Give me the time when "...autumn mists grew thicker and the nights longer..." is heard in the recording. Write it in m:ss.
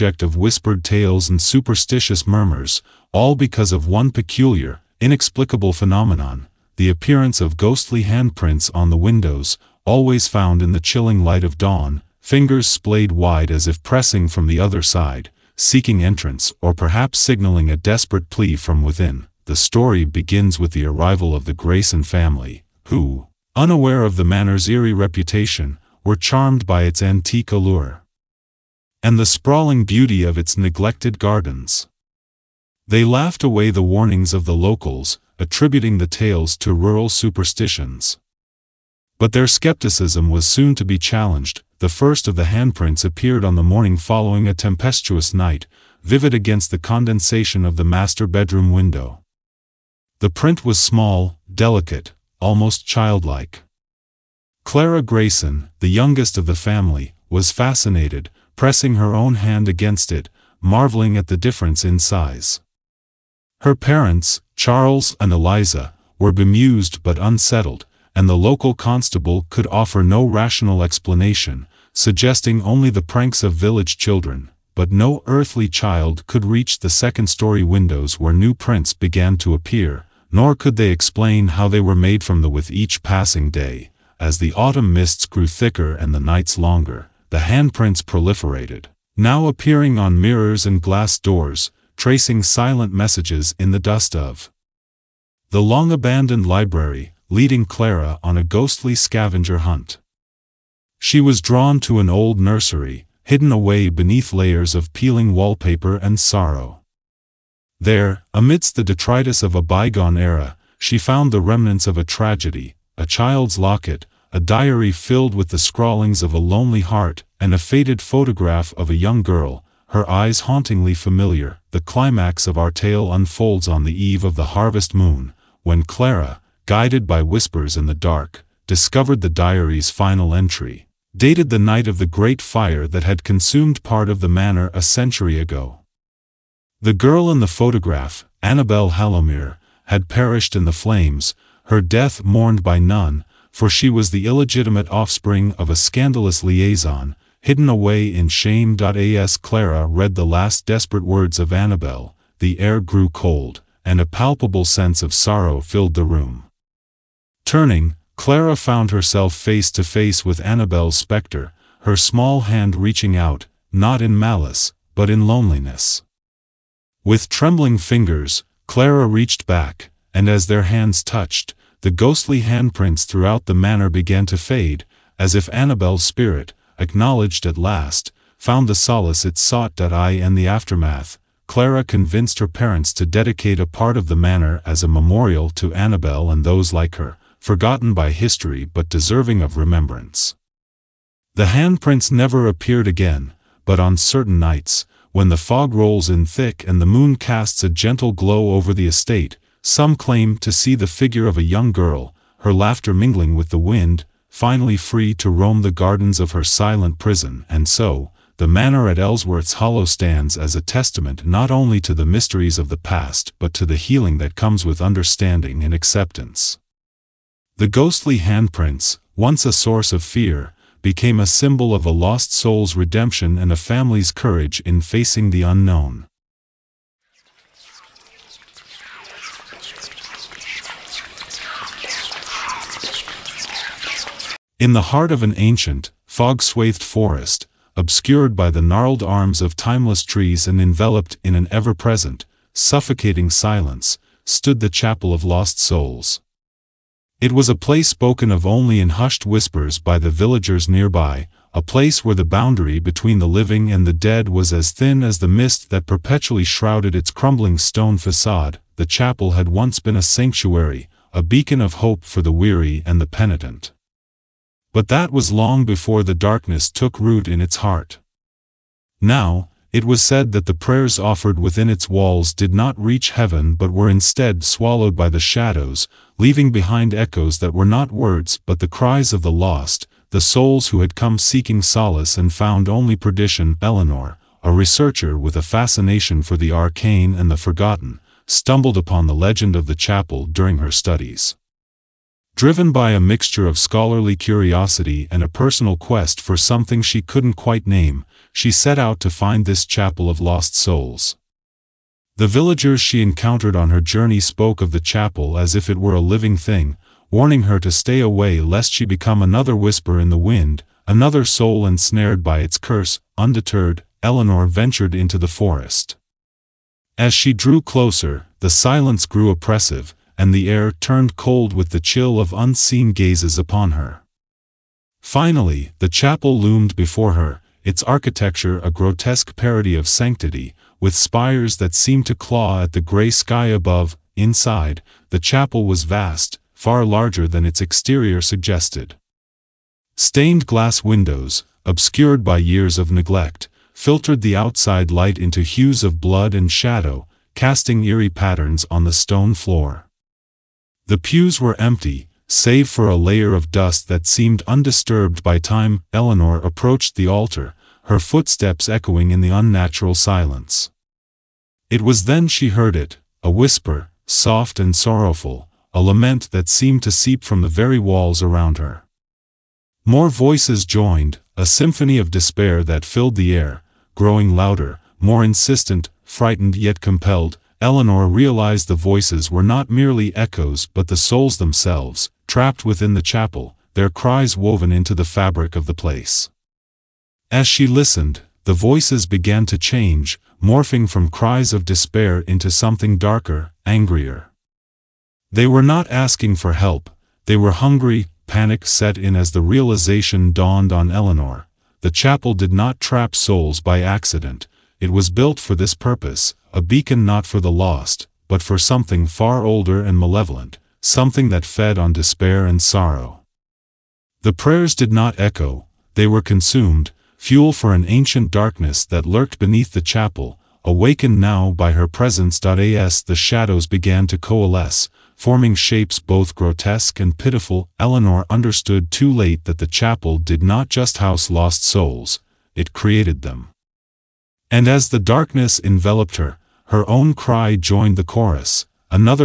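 1:24.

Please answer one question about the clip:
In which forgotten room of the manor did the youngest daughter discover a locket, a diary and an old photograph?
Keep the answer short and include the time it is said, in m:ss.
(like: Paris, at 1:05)
an old nursery, at 1:42.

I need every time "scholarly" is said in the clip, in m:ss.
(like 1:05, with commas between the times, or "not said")
4:53.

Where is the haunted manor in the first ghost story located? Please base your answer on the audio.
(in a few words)
Ellsworth's Hollow.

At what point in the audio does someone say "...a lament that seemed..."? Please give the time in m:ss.
6:05.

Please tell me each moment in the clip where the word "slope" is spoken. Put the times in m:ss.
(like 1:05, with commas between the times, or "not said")
not said.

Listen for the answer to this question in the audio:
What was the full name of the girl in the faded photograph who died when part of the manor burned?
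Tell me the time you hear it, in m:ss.
2:18.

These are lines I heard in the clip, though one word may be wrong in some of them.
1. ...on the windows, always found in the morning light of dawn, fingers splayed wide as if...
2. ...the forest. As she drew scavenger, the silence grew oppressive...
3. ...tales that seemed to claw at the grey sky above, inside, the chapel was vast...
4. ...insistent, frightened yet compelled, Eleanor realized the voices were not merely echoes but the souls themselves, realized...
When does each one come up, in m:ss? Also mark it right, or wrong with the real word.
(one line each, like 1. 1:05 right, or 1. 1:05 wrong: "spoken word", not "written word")
1. 0:08 wrong: "chilling", not "morning"
2. 5:15 wrong: "closer", not "scavenger"
3. 5:30 wrong: "spires", not "tales"
4. 6:15 wrong: "trapped", not "realized".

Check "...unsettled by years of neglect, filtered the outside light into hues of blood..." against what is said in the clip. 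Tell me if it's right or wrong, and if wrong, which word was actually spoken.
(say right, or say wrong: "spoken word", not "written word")
wrong: "obscured", not "unsettled".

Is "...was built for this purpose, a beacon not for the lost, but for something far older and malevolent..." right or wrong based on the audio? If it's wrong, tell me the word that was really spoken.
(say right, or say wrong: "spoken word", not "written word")
right.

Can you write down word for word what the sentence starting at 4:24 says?
But that was long before the darkness took root in its heart.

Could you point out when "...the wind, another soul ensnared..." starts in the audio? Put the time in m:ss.
5:10.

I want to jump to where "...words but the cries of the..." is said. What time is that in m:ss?
4:37.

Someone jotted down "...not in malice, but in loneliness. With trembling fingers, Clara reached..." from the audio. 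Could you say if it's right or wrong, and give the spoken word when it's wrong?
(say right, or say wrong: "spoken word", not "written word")
right.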